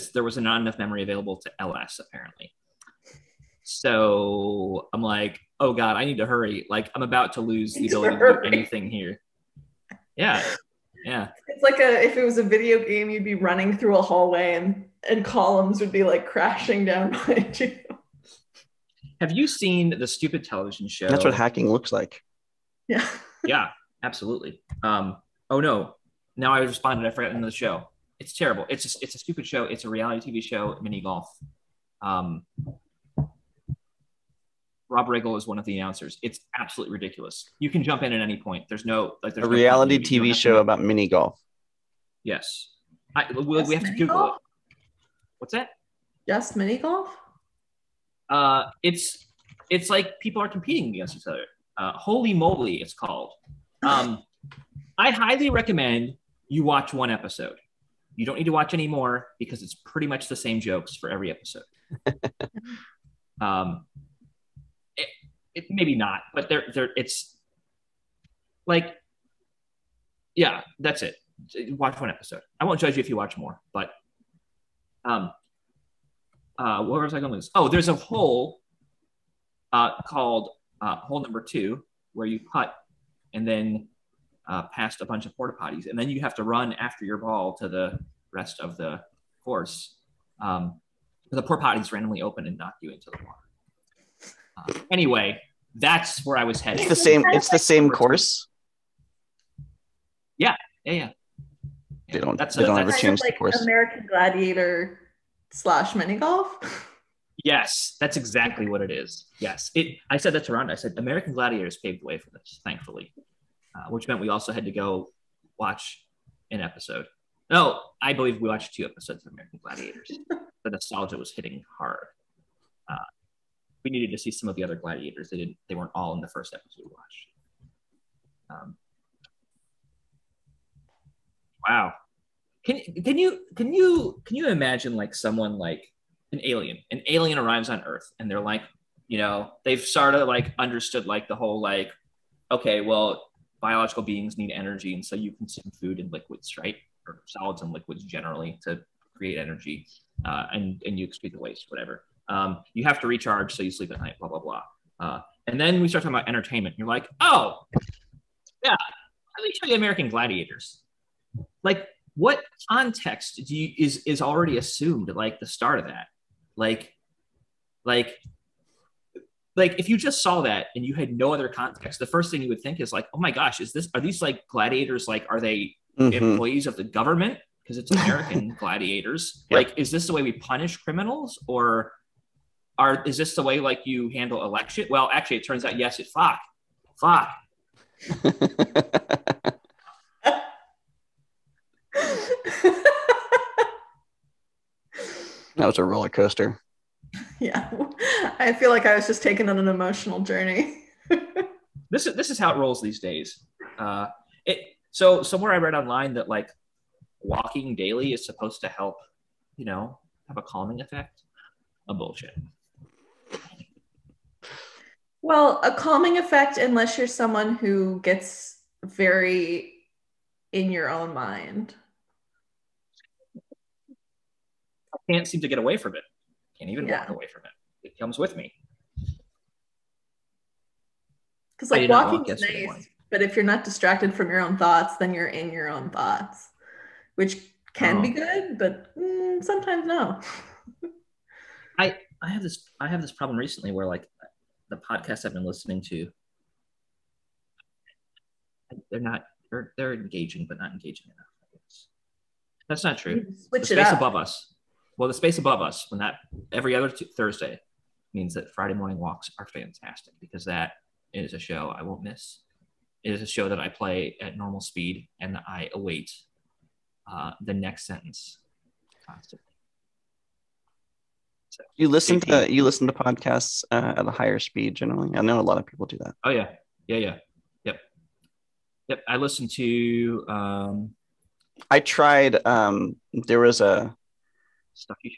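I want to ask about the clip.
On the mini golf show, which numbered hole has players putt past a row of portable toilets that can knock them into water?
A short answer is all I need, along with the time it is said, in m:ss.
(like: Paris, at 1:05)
hole number two, at 1:20.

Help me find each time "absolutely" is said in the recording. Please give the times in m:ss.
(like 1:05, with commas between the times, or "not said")
0:24, 0:36.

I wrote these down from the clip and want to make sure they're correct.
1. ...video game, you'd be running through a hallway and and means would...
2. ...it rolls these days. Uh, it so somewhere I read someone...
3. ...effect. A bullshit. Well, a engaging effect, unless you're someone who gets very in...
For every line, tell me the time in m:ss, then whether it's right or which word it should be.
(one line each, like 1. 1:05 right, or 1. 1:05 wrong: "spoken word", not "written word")
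1. 0:12 wrong: "columns", not "means"
2. 3:22 wrong: "online", not "someone"
3. 3:30 wrong: "calming", not "engaging".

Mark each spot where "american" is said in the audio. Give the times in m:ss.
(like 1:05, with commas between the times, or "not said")
1:43, 1:50, 1:59, 2:39, 2:58.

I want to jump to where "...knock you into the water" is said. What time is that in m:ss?
1:32.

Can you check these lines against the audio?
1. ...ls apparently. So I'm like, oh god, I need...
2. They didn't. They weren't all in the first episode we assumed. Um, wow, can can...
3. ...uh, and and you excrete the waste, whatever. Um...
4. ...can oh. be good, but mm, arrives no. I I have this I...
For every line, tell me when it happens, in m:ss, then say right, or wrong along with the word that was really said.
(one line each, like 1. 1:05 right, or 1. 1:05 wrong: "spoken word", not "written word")
1. 0:01 right
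2. 2:05 wrong: "watched", not "assumed"
3. 2:30 right
4. 3:57 wrong: "sometimes", not "arrives".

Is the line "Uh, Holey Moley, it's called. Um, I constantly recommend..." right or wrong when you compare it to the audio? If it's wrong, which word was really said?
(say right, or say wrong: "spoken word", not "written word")
wrong: "highly", not "constantly".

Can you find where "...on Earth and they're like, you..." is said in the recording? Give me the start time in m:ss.
2:17.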